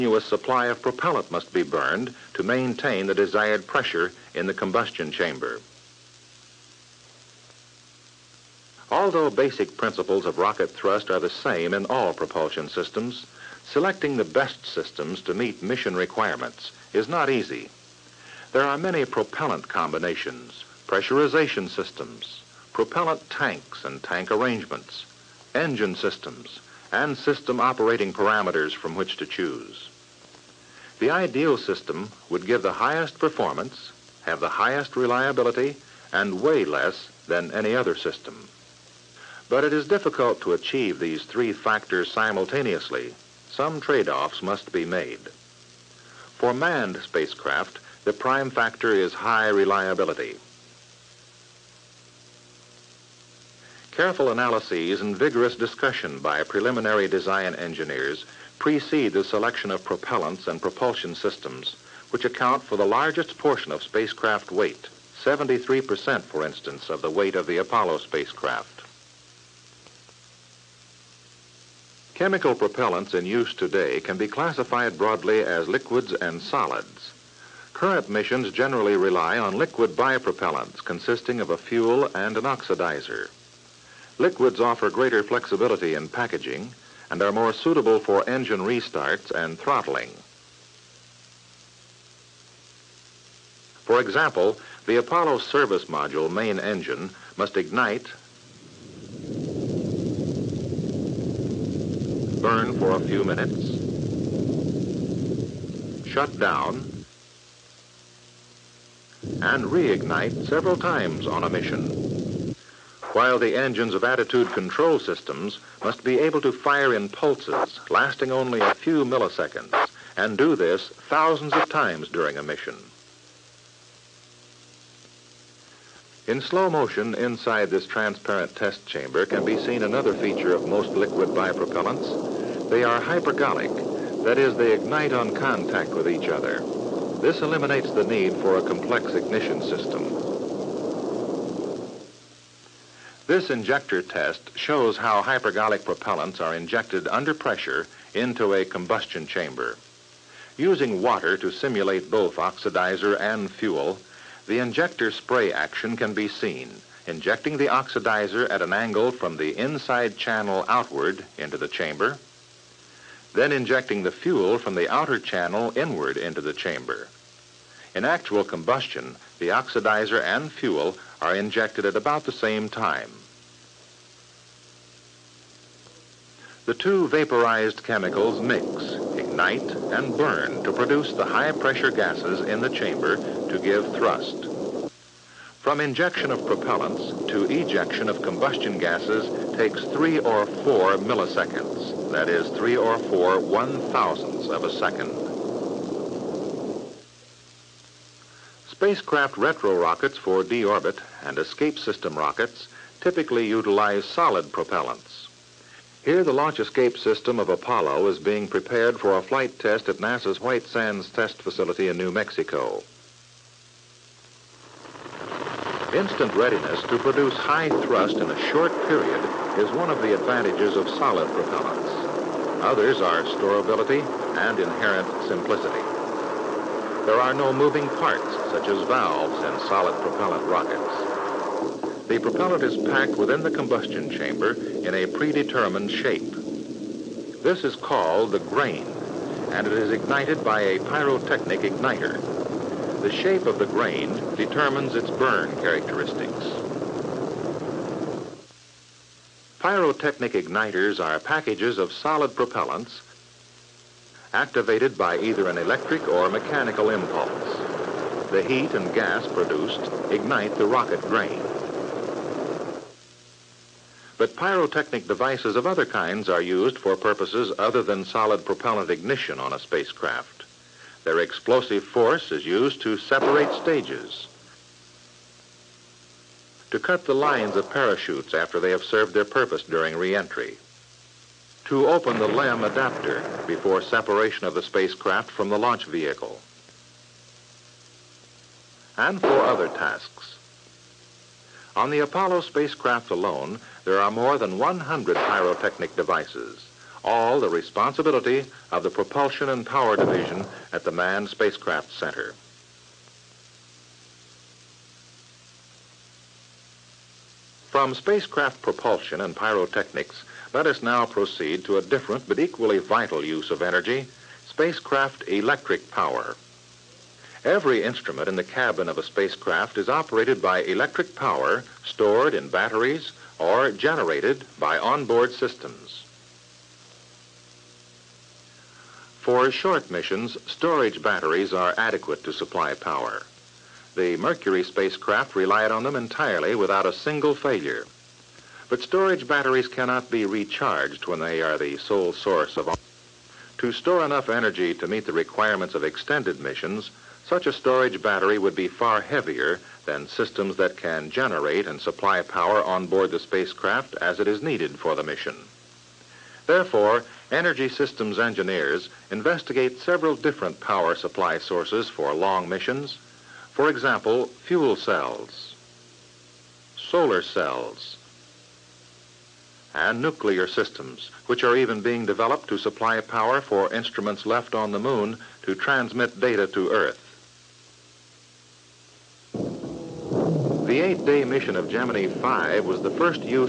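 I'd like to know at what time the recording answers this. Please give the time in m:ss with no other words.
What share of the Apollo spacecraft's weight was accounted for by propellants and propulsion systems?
1:05.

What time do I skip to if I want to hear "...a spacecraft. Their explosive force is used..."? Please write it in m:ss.
4:29.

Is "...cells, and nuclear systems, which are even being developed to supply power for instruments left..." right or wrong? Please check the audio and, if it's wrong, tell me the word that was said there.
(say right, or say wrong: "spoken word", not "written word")
right.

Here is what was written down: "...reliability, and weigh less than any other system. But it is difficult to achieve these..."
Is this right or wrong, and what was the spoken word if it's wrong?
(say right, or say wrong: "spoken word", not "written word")
right.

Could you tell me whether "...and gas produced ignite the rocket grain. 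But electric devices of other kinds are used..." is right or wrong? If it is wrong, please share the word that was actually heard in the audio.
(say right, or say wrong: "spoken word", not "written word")
wrong: "pyrotechnic", not "electric".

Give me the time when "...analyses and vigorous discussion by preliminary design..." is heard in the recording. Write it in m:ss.
0:54.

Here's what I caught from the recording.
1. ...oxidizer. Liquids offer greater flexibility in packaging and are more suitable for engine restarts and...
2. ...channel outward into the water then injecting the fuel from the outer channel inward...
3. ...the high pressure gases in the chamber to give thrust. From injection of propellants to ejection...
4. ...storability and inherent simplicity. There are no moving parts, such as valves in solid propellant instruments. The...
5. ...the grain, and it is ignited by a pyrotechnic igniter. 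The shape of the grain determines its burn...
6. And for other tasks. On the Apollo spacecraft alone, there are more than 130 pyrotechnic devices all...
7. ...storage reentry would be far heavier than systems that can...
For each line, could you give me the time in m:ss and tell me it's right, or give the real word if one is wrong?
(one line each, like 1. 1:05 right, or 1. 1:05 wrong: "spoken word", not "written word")
1. 1:22 right
2. 2:40 wrong: "chamber", not "water"
3. 3:01 right
4. 3:43 wrong: "rockets", not "instruments"
5. 3:58 right
6. 4:48 wrong: "100", not "130"
7. 5:47 wrong: "battery", not "reentry".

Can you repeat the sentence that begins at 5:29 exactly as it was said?
For short missions, storage batteries are adequate to supply power.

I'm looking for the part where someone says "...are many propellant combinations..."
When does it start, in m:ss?
0:18.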